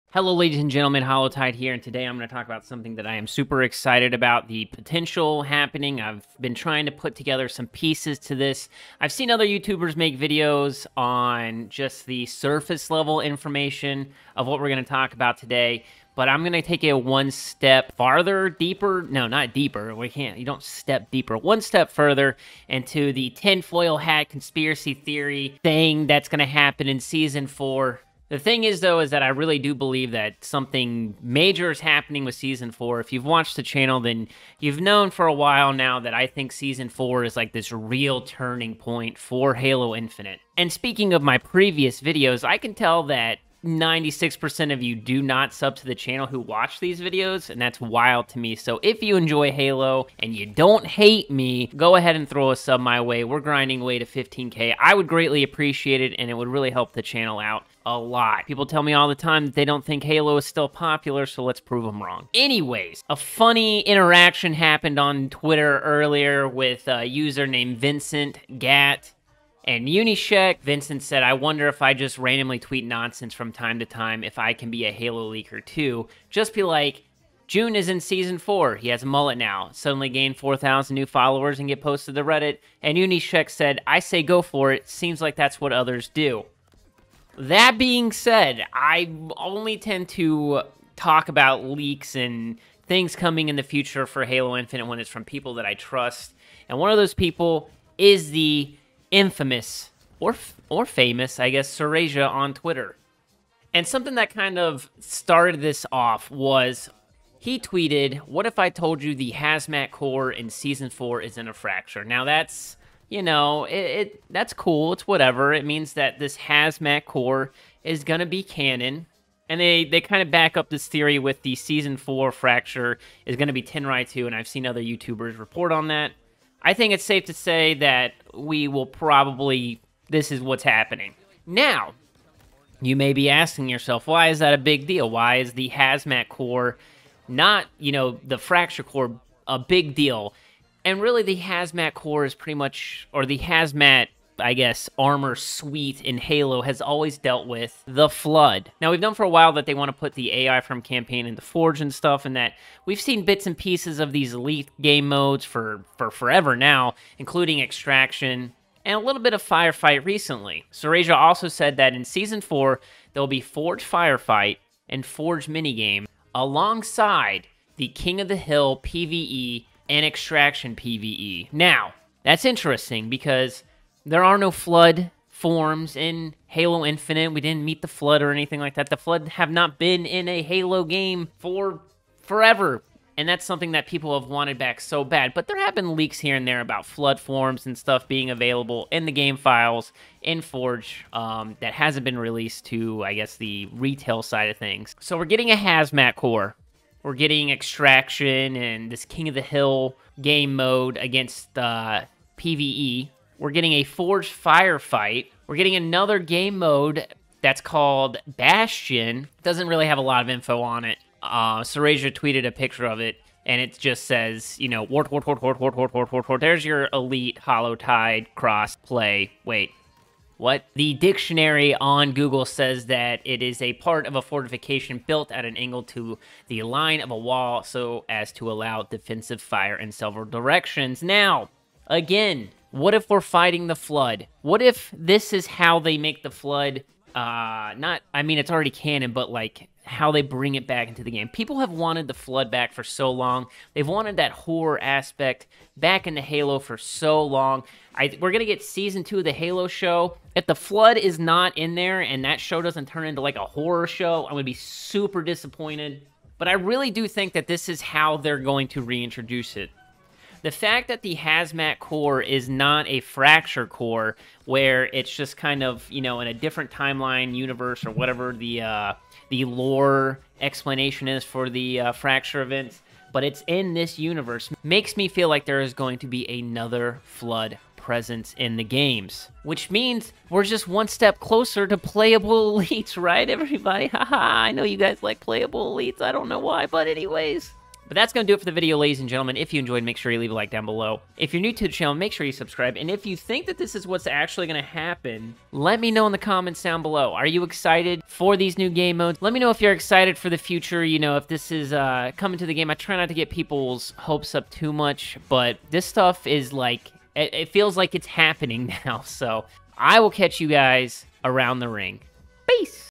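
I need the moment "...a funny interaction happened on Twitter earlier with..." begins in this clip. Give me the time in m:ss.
1:03.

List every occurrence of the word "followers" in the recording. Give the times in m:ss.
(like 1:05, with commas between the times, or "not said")
1:21.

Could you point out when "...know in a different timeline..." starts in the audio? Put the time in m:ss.
4:26.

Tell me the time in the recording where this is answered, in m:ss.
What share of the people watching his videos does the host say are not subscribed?
0:43.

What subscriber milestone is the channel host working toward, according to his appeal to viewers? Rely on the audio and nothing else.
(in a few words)
15K.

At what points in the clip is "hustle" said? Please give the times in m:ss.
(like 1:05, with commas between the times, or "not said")
not said.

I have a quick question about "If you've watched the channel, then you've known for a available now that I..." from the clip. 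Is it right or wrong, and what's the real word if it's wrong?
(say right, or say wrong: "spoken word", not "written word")
wrong: "while", not "available".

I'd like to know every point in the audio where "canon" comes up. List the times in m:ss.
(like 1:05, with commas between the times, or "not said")
1:58, 3:58.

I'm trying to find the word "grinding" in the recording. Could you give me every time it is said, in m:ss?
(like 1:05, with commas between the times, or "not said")
0:53.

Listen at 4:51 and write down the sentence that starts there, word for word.
If you're new to the channel, make sure you subscribe.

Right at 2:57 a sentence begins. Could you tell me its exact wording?
We didn't meet the flood or anything like that.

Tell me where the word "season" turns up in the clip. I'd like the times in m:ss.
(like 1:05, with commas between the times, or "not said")
0:26, 0:32, 0:36, 1:17, 1:50, 2:01, 2:42, 4:08.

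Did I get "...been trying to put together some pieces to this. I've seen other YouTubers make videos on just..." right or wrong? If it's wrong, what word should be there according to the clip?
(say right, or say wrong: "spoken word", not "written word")
right.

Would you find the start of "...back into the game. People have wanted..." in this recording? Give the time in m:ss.
4:00.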